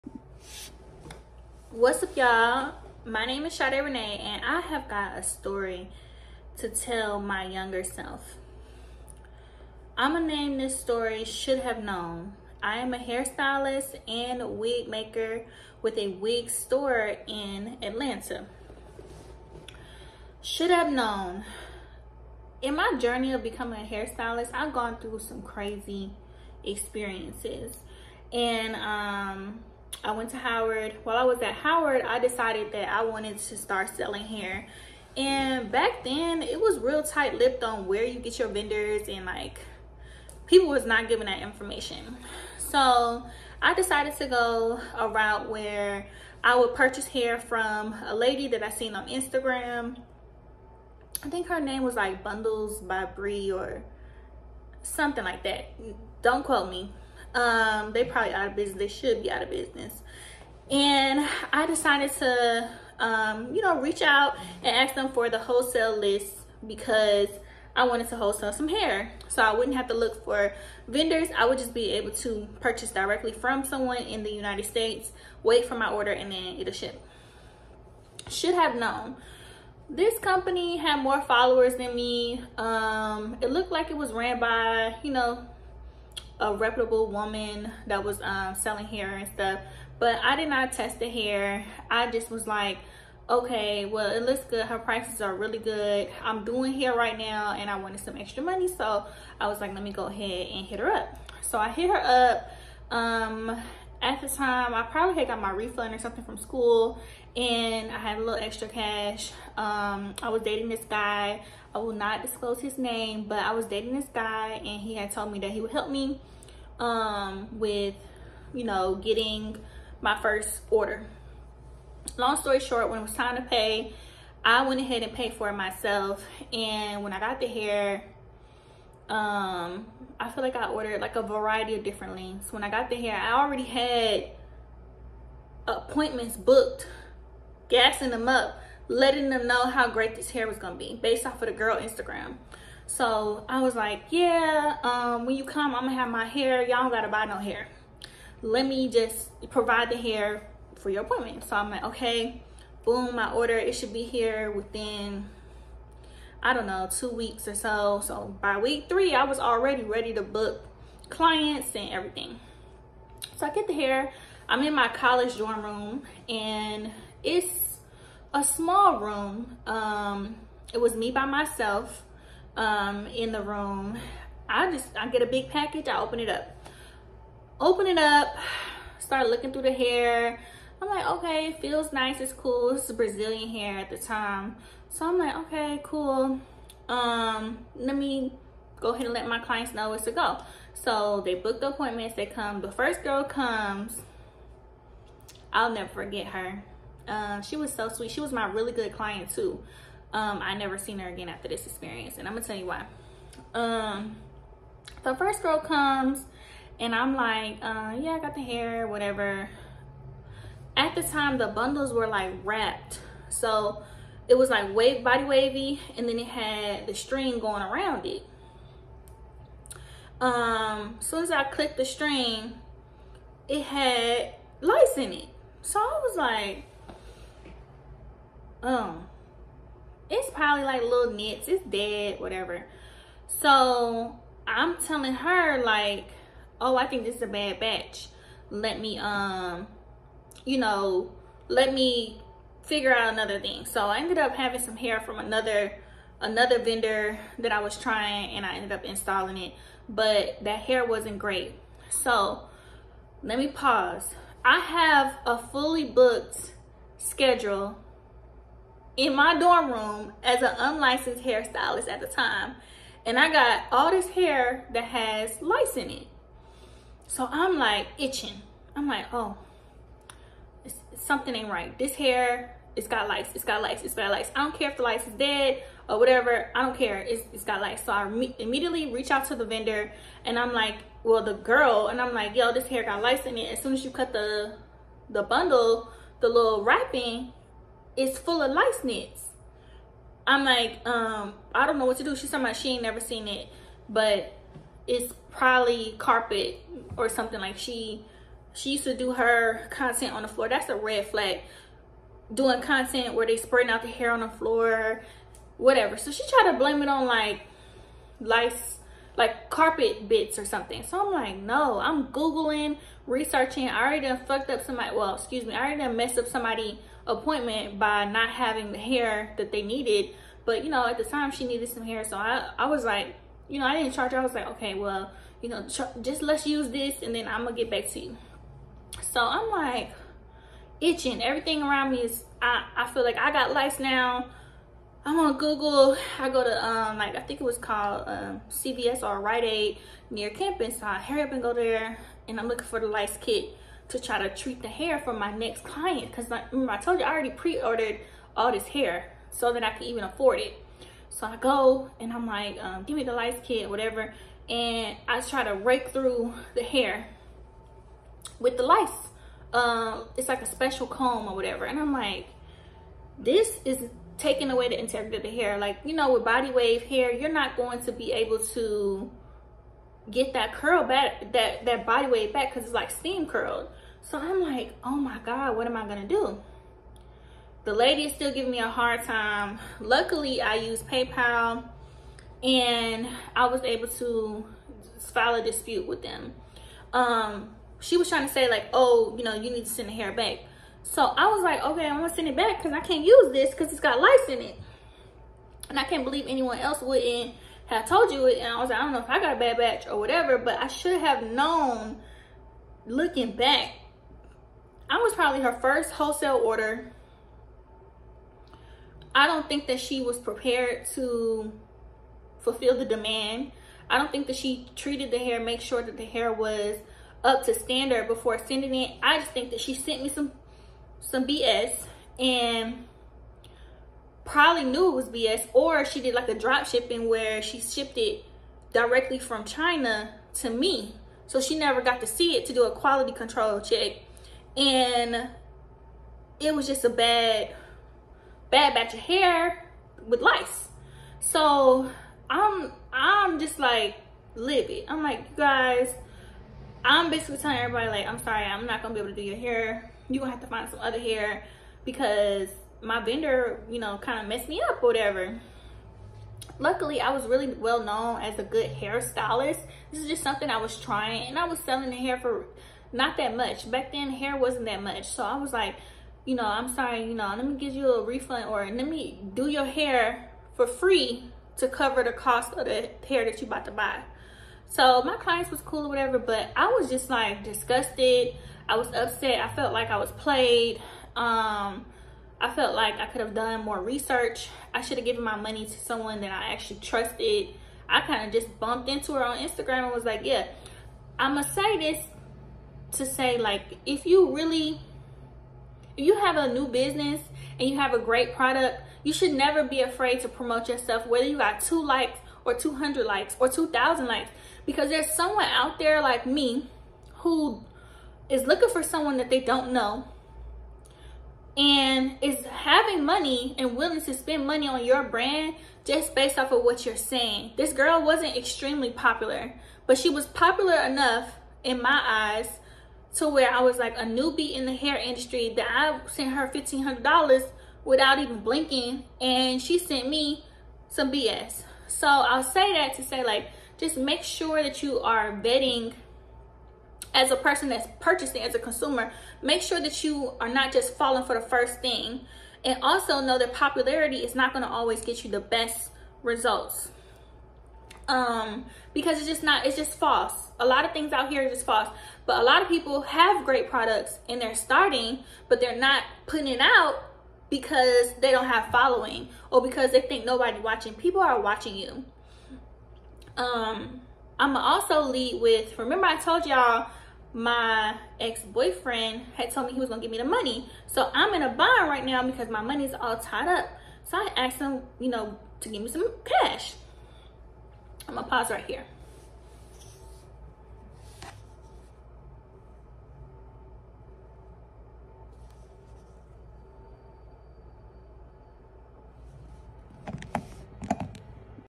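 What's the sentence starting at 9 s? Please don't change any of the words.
I'm gonna name this story Should Have Known.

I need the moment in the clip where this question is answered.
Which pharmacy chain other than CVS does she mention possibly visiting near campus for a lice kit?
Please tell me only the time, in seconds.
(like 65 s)
339 s.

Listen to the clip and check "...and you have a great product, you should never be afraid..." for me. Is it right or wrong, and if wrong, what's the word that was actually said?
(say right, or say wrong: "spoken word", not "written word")
right.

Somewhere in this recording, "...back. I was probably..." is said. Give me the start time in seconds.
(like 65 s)
403 s.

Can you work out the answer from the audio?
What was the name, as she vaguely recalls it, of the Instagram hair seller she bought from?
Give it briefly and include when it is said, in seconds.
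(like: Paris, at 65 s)
Bundles by Bree, at 52 s.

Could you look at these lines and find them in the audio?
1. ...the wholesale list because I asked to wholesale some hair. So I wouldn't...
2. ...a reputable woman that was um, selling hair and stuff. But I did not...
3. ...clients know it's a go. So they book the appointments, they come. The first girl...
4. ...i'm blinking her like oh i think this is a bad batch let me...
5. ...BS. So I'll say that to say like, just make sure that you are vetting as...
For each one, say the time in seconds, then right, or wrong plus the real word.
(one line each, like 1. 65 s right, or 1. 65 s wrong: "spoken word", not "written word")
1. 65 s wrong: "wanted", not "asked"
2. 86 s right
3. 189 s right
4. 234 s wrong: "telling", not "blinking"
5. 531 s right.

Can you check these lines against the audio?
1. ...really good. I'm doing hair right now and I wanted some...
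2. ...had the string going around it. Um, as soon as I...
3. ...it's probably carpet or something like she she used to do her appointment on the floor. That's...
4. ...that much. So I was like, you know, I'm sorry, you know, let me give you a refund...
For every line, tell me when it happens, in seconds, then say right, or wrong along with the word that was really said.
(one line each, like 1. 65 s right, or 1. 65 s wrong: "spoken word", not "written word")
1. 95 s right
2. 216 s right
3. 294 s wrong: "content", not "appointment"
4. 464 s right.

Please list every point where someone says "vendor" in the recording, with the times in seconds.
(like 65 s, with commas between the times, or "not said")
38 s, 70 s, 246 s, 279 s, 453 s.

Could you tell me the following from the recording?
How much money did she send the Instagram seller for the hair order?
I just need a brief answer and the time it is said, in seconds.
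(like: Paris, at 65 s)
$1,500, at 526 s.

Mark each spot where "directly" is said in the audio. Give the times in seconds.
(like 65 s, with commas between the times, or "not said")
72 s, 428 s.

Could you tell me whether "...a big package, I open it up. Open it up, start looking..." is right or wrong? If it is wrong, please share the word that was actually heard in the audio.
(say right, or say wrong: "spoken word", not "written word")
right.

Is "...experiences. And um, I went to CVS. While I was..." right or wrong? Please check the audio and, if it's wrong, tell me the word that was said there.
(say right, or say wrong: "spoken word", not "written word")
wrong: "Howard", not "CVS".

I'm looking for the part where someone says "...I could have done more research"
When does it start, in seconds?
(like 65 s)
482 s.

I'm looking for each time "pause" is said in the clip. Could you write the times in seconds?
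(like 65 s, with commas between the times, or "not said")
253 s, 578 s.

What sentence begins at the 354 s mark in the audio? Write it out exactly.
And I try to rake through the hair with the lice.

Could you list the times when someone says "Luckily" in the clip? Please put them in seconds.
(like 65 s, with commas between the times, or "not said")
379 s, 456 s.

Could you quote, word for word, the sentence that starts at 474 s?
So my clients was cool or whatever, but I was just like disgusted.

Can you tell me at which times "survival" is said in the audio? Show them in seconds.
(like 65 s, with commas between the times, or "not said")
not said.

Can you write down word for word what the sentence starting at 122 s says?
Long story short, when it was time to pay, I went ahead and paid for it myself.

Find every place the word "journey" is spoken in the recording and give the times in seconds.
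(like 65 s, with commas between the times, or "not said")
22 s.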